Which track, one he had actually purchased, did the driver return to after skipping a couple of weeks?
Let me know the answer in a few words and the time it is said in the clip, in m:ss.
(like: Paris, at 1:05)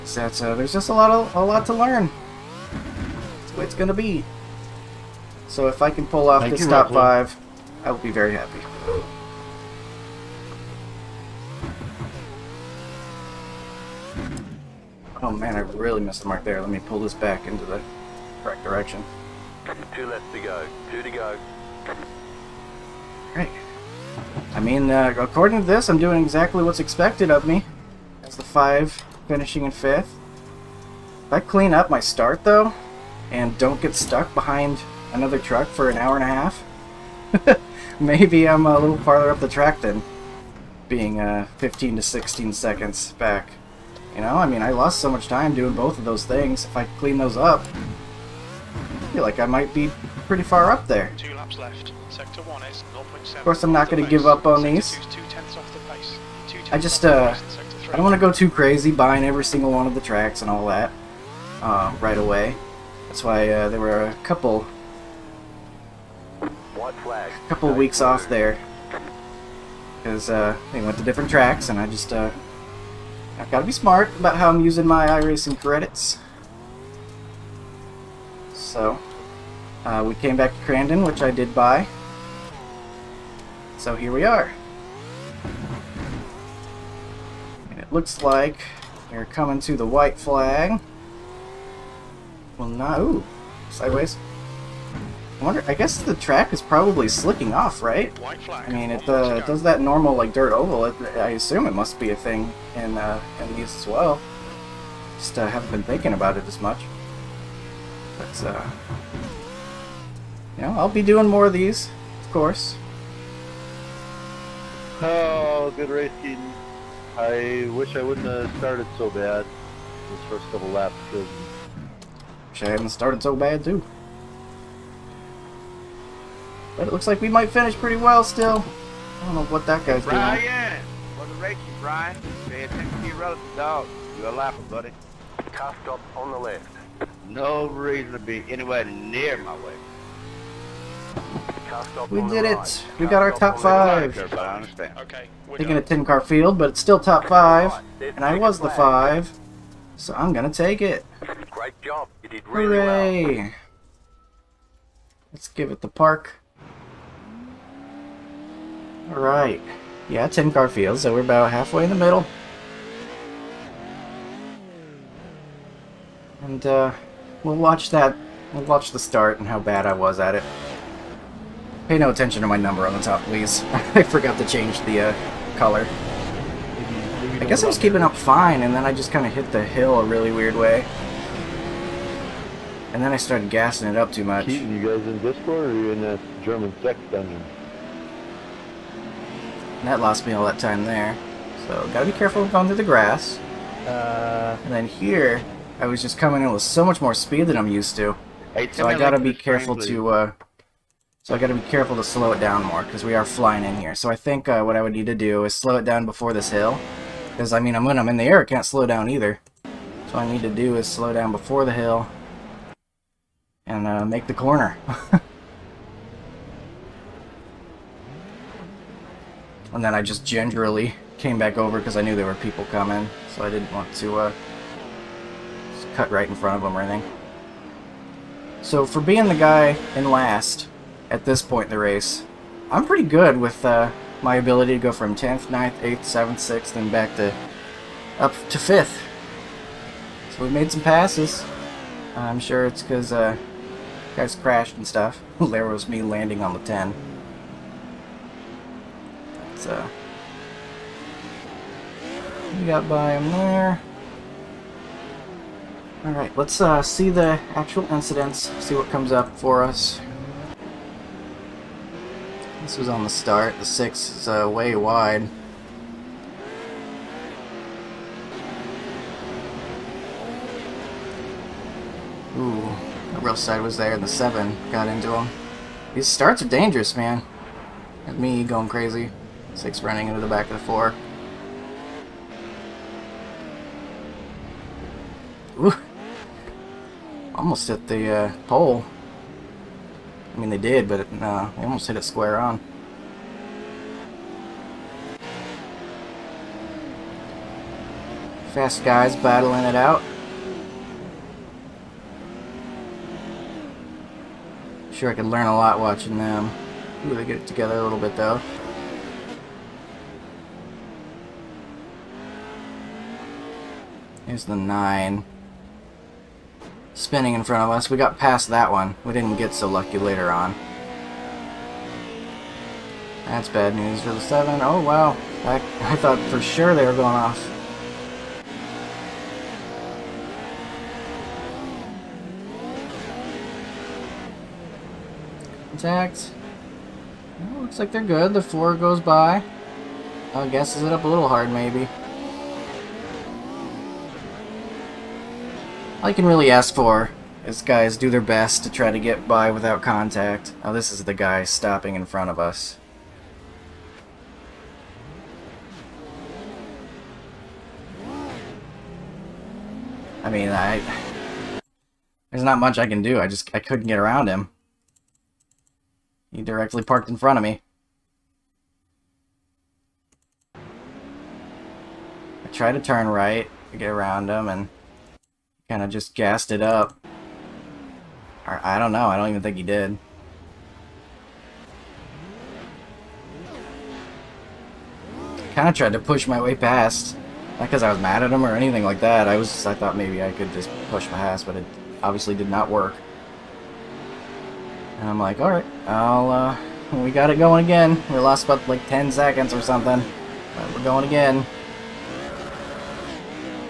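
Crandon, at 1:20.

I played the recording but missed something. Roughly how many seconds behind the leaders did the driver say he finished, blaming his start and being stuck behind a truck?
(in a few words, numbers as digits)
15 to 16 seconds.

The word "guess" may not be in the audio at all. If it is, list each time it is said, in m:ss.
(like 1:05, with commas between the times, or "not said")
1:35, 2:57, 5:40.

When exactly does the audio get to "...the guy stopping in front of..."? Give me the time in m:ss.
5:51.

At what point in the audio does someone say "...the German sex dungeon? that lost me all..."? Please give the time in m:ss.
3:06.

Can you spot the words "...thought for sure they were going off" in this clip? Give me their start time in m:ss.
5:25.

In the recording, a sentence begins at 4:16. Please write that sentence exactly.
Alright, let's uh, see the actual incidents, see what comes up for us.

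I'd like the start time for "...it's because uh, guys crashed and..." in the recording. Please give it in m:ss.
4:02.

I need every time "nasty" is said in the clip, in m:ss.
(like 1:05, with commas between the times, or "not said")
not said.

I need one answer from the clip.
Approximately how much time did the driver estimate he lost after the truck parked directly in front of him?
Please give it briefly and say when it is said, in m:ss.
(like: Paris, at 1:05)
About 10 seconds, at 6:38.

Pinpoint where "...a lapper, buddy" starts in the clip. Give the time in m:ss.
2:14.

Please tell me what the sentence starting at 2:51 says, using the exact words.
Pay no attention to my number on the top, please.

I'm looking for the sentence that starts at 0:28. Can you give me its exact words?
That's the five, finishing in fifth.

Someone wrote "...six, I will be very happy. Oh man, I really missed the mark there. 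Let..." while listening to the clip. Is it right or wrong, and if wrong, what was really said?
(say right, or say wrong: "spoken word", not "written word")
wrong: "five", not "six".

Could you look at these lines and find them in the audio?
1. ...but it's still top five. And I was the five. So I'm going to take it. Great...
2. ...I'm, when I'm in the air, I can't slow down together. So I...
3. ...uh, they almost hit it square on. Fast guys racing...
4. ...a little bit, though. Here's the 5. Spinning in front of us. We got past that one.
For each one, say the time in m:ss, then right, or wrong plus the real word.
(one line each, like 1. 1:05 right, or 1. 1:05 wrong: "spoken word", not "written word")
1. 2:26 right
2. 3:27 wrong: "either", not "together"
3. 4:51 wrong: "battling", not "racing"
4. 5:07 wrong: "9", not "5".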